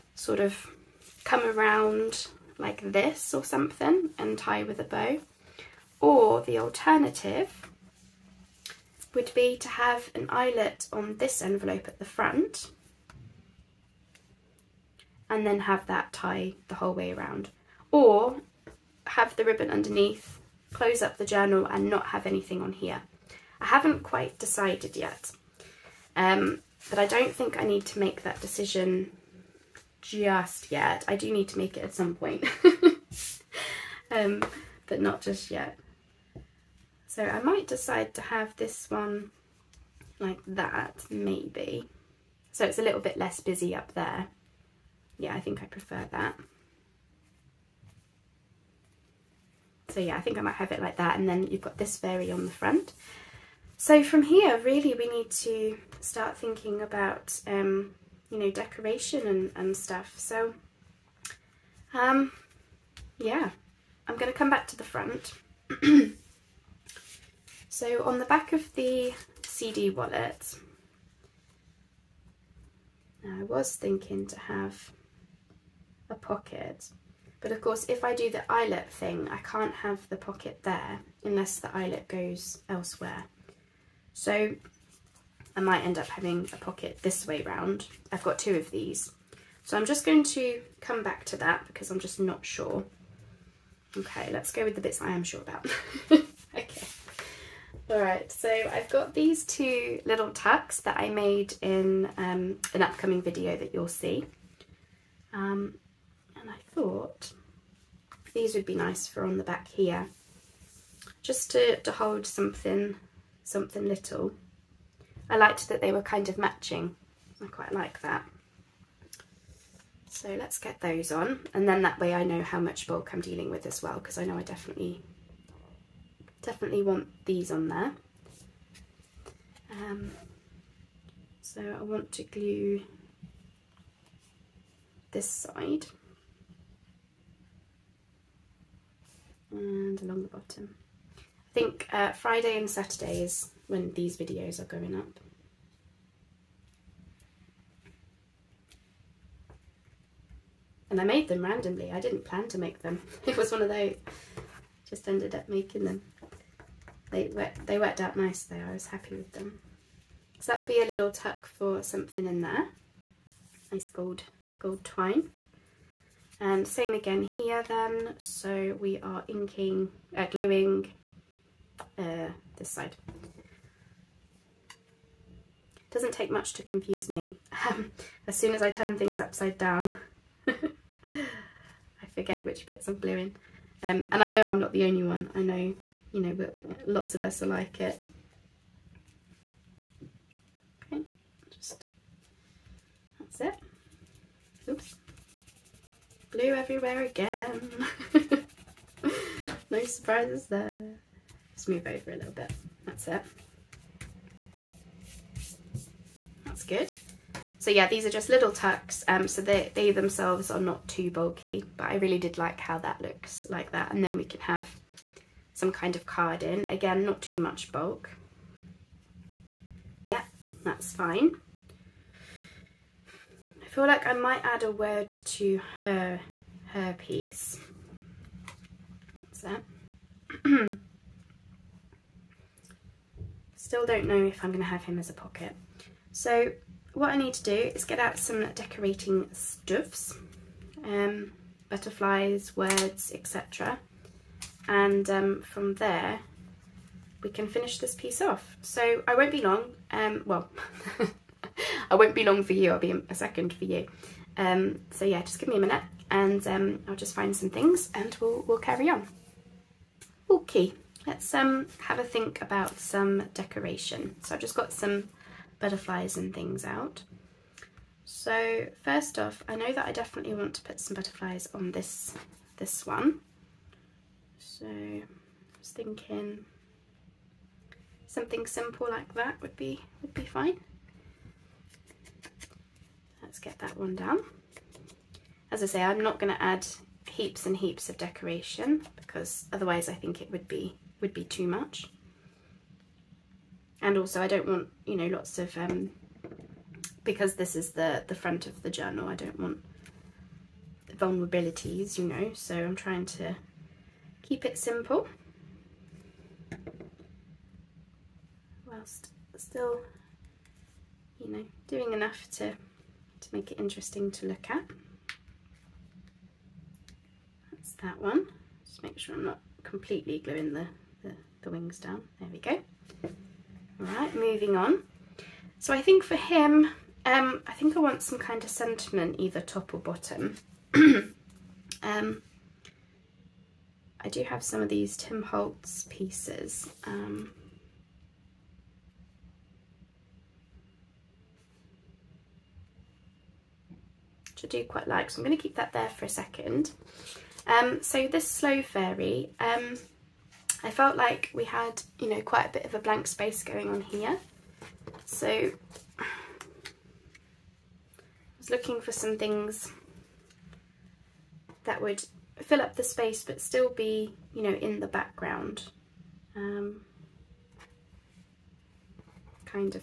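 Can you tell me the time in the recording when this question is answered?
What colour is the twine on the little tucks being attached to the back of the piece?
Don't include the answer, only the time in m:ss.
2:44.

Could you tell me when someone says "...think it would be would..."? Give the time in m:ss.
4:49.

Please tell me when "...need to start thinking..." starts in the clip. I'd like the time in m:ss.
0:55.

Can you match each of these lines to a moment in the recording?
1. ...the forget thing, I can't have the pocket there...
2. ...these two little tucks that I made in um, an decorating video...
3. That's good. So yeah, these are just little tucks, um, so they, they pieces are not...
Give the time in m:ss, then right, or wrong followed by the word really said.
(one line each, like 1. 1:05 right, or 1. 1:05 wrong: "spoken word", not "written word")
1. 1:18 wrong: "eyelet", not "forget"
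2. 1:39 wrong: "upcoming", not "decorating"
3. 3:26 wrong: "themselves", not "pieces".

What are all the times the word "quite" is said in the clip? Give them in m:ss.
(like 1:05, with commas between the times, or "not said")
0:24, 1:57, 5:44, 5:52.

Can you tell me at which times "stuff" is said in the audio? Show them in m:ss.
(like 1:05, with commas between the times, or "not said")
0:59, 3:59.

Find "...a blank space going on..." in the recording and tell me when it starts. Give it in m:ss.
5:52.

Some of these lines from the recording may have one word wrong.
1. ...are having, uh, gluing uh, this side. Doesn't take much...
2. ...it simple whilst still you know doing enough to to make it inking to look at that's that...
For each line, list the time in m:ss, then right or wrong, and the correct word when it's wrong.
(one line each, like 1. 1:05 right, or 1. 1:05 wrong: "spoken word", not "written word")
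1. 2:49 wrong: "inking", not "having"
2. 5:04 wrong: "interesting", not "inking".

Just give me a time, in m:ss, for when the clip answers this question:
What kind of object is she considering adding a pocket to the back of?
1:09.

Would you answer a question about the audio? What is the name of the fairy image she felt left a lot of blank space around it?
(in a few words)
Sloe Fairy.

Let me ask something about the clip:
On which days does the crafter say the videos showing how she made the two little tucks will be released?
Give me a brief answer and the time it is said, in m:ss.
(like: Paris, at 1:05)
Friday and Saturday, at 2:22.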